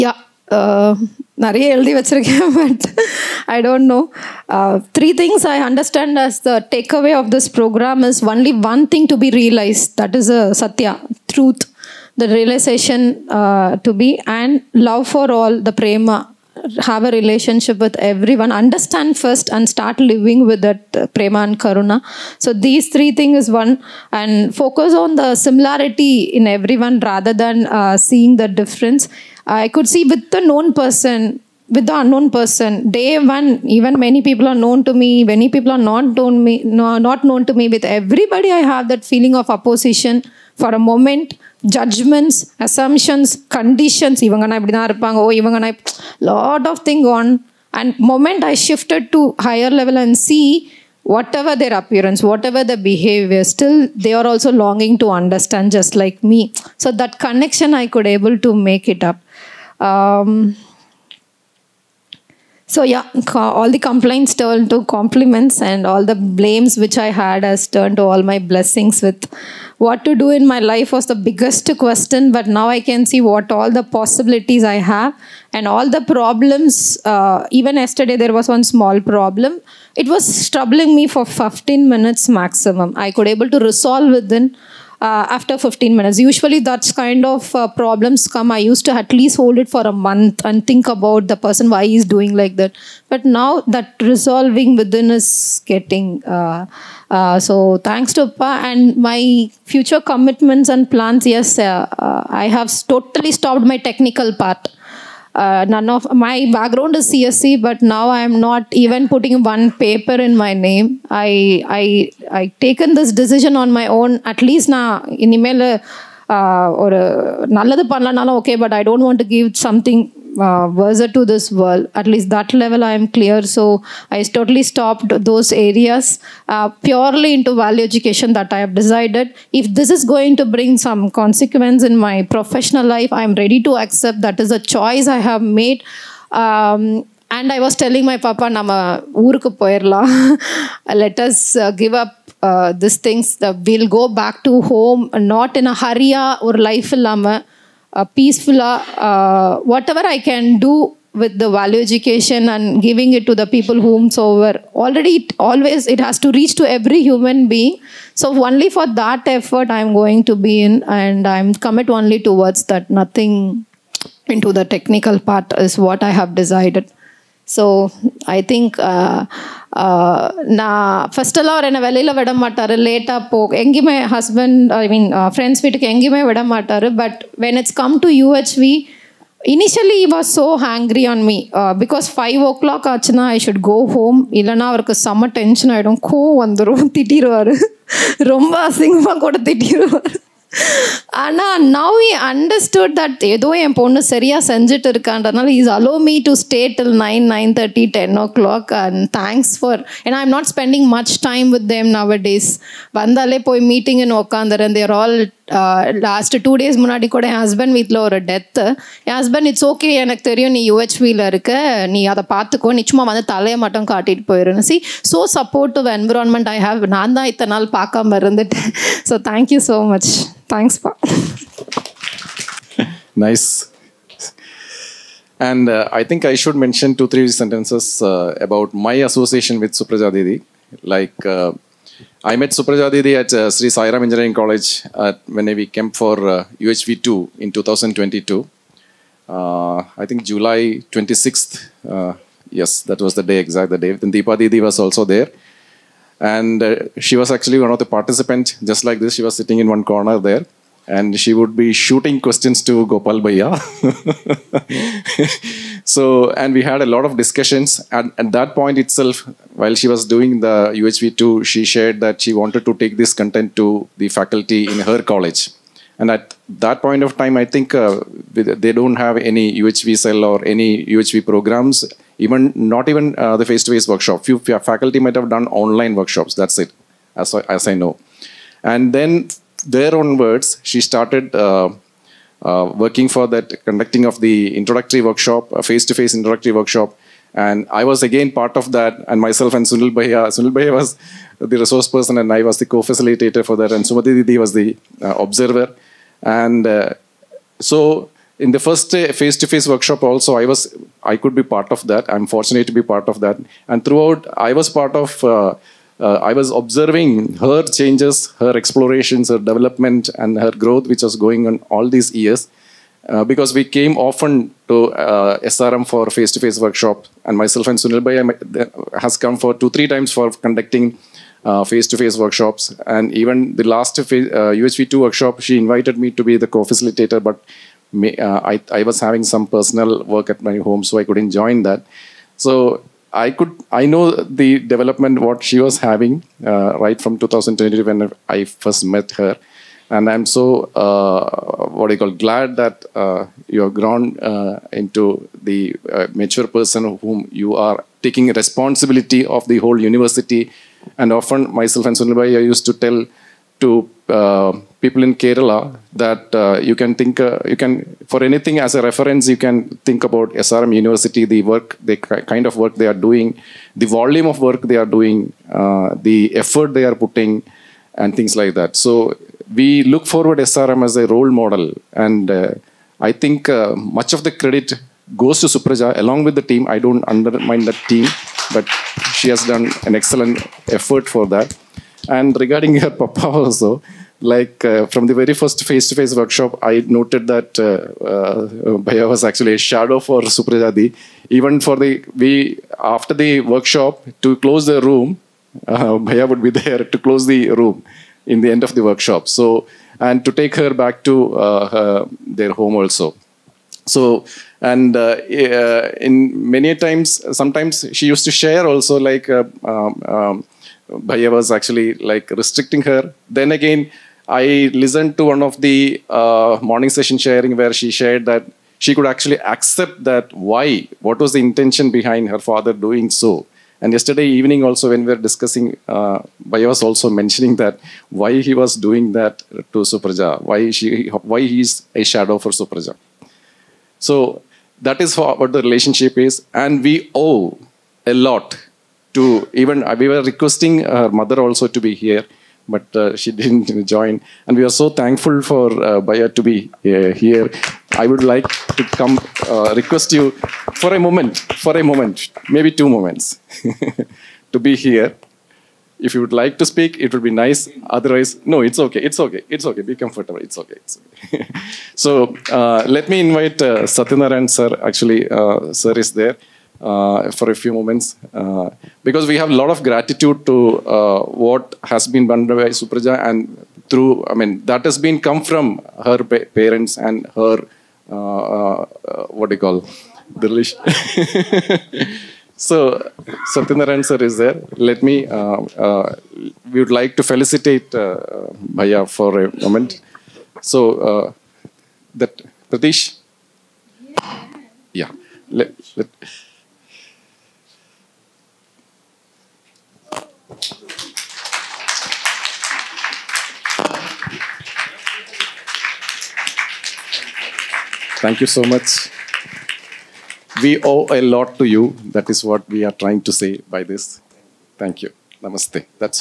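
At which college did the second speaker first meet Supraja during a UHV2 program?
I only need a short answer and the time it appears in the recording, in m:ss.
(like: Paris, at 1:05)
Sri Sairam Engineering College, at 3:53.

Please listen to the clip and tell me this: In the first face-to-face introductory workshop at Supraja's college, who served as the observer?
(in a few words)
Sumati Didi.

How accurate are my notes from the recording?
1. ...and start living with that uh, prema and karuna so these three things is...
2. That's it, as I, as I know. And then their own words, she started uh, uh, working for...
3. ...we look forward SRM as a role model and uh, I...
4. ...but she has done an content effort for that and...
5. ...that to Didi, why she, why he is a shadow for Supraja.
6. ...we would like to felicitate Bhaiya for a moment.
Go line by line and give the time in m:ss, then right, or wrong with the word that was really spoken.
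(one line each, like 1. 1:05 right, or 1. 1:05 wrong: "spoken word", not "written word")
1. 0:19 right
2. 4:36 right
3. 6:09 right
4. 6:18 wrong: "excellent", not "content"
5. 7:09 wrong: "Supraja", not "Didi"
6. 8:06 right.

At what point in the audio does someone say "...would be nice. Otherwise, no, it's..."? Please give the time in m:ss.
7:37.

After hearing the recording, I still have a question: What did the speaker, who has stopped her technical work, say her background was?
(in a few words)
CSC.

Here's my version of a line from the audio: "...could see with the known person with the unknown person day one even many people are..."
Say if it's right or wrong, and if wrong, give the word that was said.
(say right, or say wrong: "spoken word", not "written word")
right.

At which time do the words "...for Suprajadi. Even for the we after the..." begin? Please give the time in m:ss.
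6:29.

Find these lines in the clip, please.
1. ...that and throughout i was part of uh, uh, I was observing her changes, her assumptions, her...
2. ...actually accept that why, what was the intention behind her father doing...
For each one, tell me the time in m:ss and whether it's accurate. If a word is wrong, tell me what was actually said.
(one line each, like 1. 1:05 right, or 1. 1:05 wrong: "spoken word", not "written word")
1. 5:03 wrong: "explorations", not "assumptions"
2. 6:59 right.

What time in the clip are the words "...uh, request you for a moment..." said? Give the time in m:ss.
7:29.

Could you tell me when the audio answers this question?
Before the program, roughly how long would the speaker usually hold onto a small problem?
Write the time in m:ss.
1:29.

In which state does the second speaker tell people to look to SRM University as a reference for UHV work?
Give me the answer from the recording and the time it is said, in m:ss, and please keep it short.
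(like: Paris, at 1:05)
Kerala, at 5:55.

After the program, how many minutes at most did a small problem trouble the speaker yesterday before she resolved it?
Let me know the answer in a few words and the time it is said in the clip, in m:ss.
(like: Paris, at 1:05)
15, at 1:21.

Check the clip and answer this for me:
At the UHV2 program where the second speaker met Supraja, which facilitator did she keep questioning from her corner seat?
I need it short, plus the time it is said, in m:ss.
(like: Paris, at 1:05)
Gopal Bhaiya, at 4:12.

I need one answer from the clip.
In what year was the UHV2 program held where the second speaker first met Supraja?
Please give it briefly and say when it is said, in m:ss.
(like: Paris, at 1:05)
2022, at 3:57.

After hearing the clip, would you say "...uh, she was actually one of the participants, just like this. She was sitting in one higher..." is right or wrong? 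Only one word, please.
wrong.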